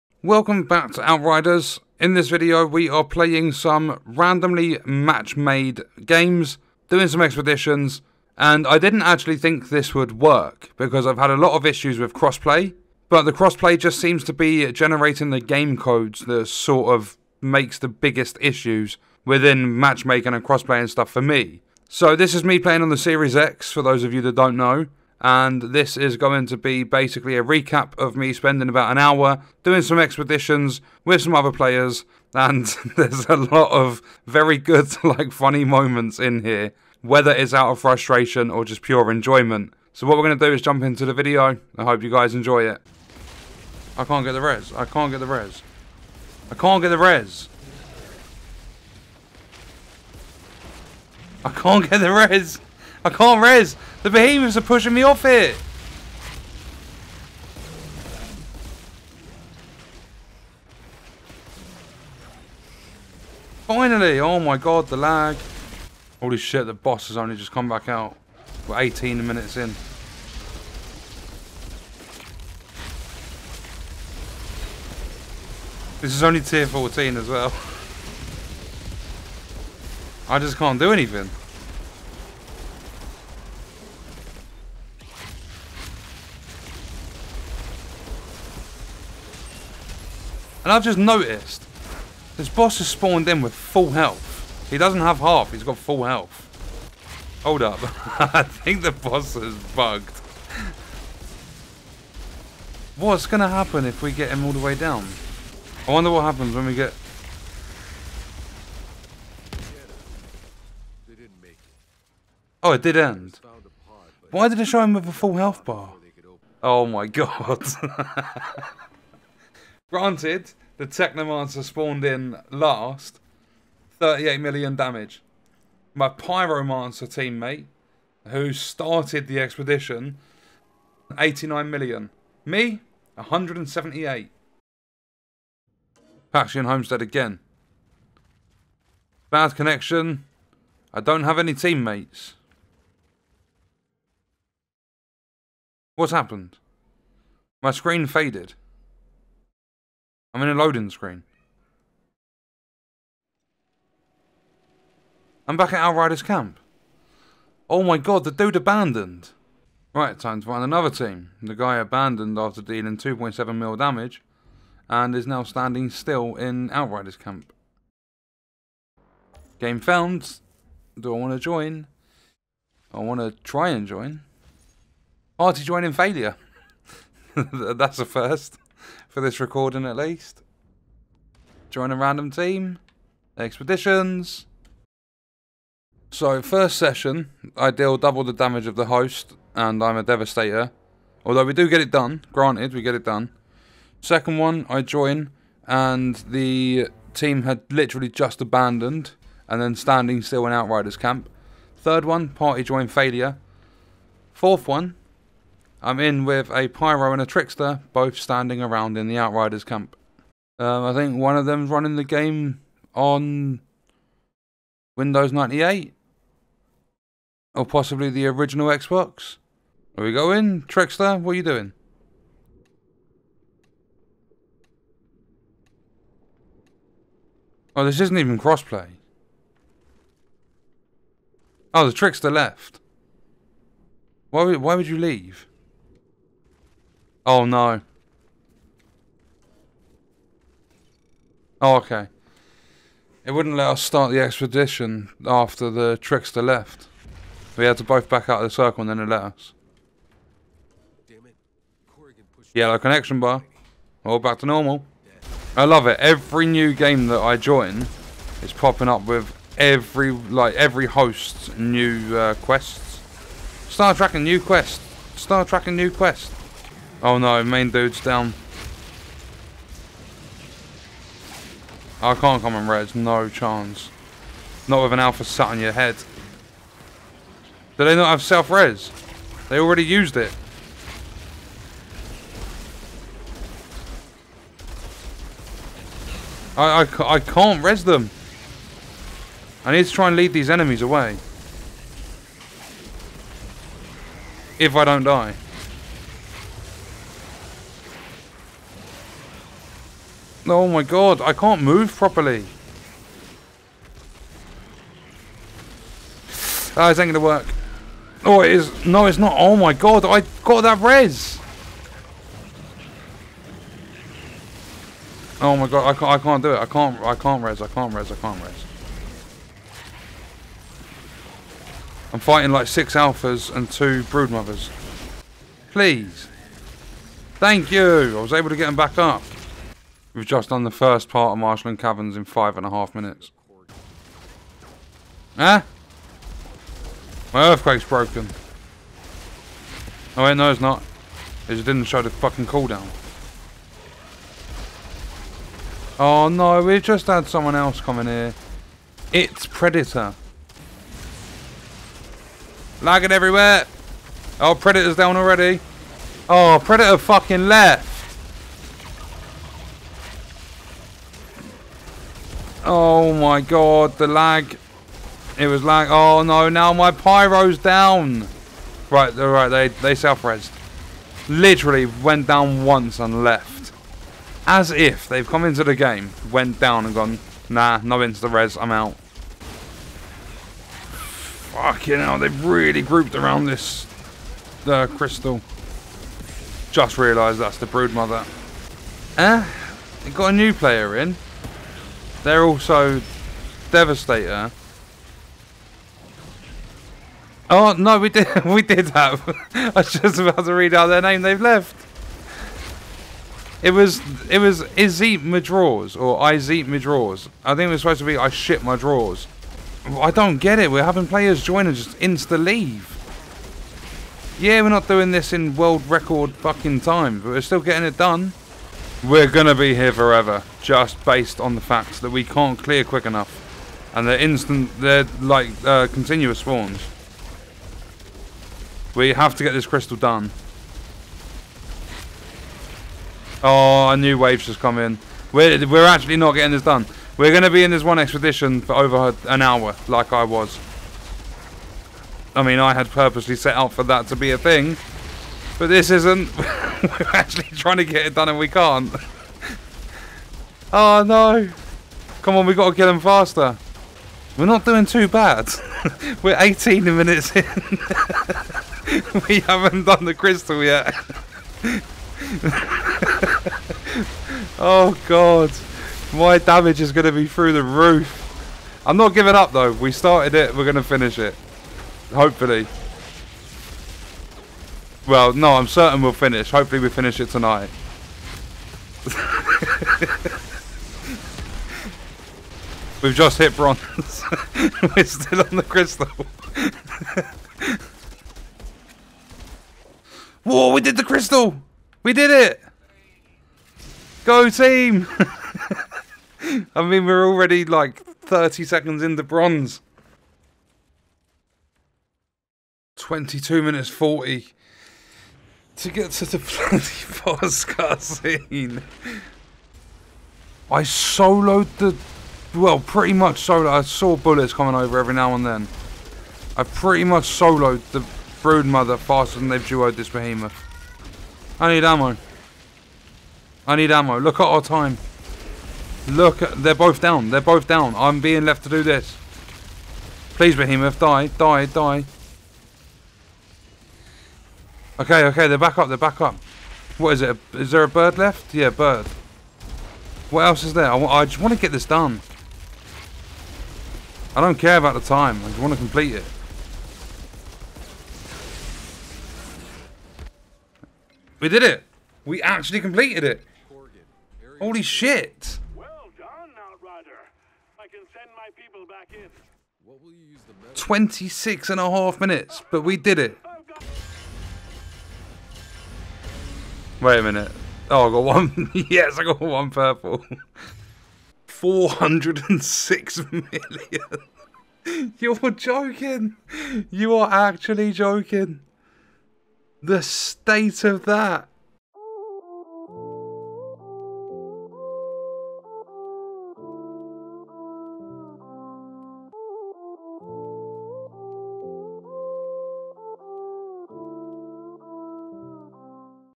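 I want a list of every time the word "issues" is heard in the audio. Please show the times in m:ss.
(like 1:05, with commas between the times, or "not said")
0:11, 0:18.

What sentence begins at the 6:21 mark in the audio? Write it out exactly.
Fucking hell, they've really grouped around this the uh, crystal.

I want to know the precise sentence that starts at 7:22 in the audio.
I mean, I had purposely set out for that to be a thing, but this isn't.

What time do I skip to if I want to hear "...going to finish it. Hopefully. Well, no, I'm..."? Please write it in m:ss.
7:50.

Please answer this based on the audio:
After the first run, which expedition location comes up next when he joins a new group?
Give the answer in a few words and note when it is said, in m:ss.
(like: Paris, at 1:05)
Paxian Homestead, at 2:16.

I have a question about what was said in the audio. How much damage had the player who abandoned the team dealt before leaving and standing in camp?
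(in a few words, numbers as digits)
2.7 mil.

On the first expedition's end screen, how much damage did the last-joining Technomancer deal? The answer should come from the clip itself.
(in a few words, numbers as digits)
38 million.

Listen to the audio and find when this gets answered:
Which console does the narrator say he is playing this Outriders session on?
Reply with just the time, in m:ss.
0:22.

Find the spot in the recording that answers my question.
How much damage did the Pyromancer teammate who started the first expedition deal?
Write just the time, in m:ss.
2:11.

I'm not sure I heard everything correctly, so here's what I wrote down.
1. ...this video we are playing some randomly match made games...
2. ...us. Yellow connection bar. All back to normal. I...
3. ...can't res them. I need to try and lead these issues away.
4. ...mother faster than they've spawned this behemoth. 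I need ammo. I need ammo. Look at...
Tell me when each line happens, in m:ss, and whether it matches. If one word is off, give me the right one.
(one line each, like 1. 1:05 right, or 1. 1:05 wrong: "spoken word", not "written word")
1. 0:02 right
2. 4:09 right
3. 4:47 wrong: "enemies", not "issues"
4. 8:38 wrong: "duoed", not "spawned".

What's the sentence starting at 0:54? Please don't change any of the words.
The behemoths are pushing me off it.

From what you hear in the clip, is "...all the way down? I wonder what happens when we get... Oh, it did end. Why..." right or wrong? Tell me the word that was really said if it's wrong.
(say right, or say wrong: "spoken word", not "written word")
right.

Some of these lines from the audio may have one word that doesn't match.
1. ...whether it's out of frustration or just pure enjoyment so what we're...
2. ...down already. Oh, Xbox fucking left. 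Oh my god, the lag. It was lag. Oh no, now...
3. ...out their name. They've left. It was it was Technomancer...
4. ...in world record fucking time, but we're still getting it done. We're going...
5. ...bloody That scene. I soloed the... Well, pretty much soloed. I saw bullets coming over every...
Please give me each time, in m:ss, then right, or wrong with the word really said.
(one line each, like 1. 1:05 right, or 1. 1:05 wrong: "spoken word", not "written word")
1. 0:37 right
2. 5:54 wrong: "Predator", not "Xbox"
3. 6:40 wrong: "Izzy", not "Technomancer"
4. 6:55 right
5. 8:26 wrong: "Boskar", not "That".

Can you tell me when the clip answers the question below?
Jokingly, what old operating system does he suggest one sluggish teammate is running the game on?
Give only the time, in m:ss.
3:34.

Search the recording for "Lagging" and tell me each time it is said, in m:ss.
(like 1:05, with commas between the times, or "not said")
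5:52.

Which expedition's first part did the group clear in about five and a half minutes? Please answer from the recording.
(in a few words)
Marshland Caverns.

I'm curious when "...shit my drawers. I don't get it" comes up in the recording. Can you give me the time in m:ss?
6:48.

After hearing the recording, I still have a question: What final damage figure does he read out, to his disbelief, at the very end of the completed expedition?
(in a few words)
406 million.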